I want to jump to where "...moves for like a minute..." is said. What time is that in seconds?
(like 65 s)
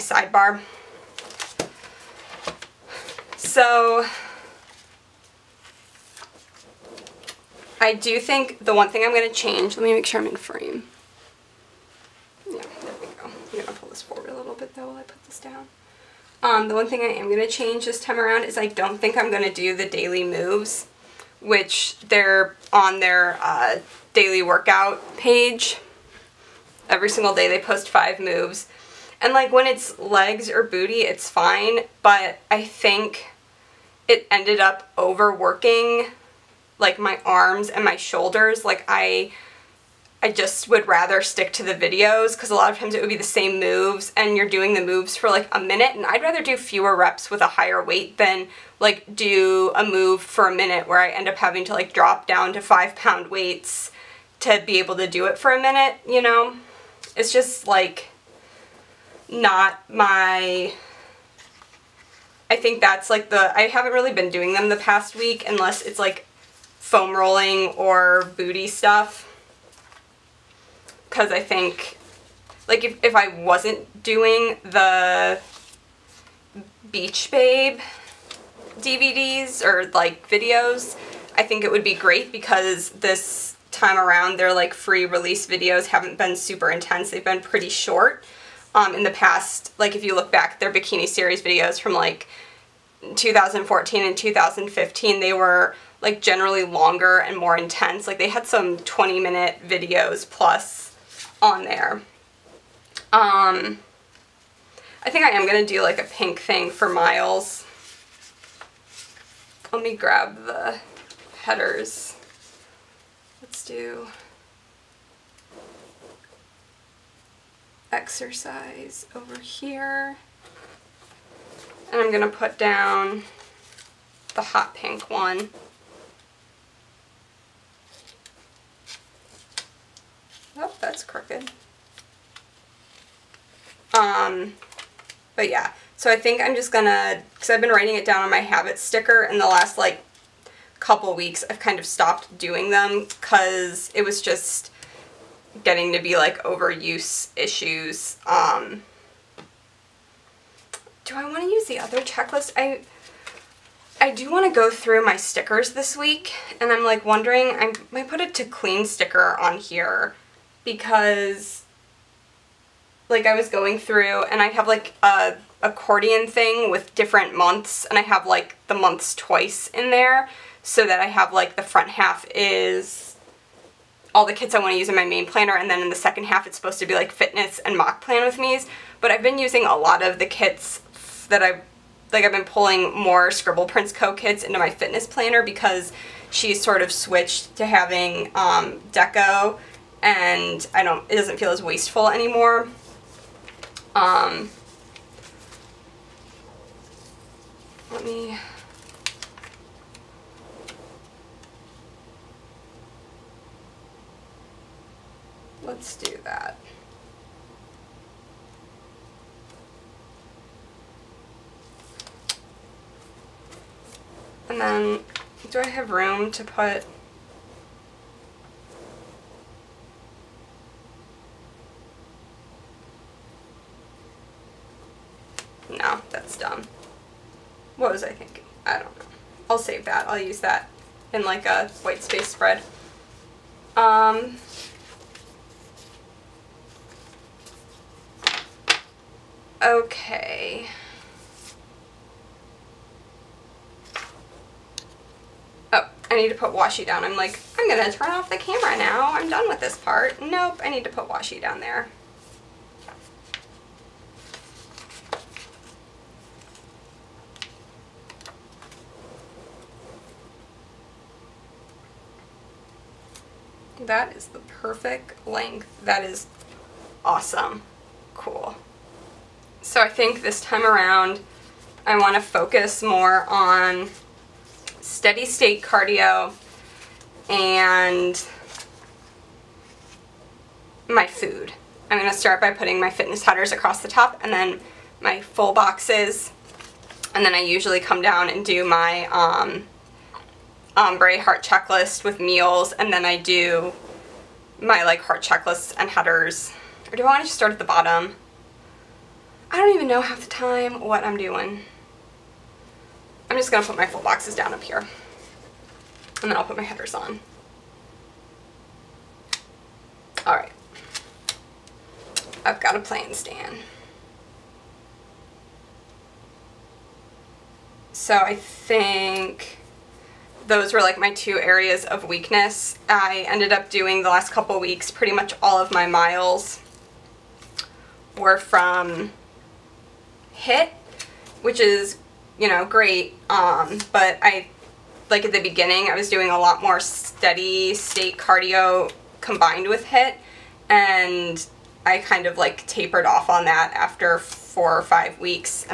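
44 s.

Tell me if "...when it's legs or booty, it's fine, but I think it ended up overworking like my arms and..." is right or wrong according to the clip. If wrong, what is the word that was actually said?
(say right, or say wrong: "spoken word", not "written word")
right.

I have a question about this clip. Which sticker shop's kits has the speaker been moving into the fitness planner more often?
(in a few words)
Scribble Prints Co.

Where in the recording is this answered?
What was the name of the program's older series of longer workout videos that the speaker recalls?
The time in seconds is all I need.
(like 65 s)
90 s.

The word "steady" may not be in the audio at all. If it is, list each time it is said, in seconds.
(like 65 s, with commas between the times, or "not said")
274 s, 336 s.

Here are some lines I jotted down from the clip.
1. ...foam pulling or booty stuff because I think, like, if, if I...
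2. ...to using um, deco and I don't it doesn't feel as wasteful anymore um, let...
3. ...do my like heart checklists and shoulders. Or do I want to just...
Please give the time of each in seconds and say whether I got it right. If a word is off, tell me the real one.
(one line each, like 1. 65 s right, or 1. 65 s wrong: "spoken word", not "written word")
1. 66 s wrong: "rolling", not "pulling"
2. 187 s wrong: "having", not "using"
3. 293 s wrong: "headers", not "shoulders".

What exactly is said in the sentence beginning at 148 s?
Um, do I want to use the other checklist?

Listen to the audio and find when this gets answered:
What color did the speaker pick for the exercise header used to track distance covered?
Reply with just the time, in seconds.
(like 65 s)
124 s.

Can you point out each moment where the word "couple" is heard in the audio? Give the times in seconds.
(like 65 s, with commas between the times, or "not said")
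140 s, 324 s.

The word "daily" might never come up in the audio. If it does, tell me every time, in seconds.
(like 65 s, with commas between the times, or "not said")
19 s, 24 s.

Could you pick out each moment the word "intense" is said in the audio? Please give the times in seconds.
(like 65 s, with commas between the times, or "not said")
86 s, 97 s.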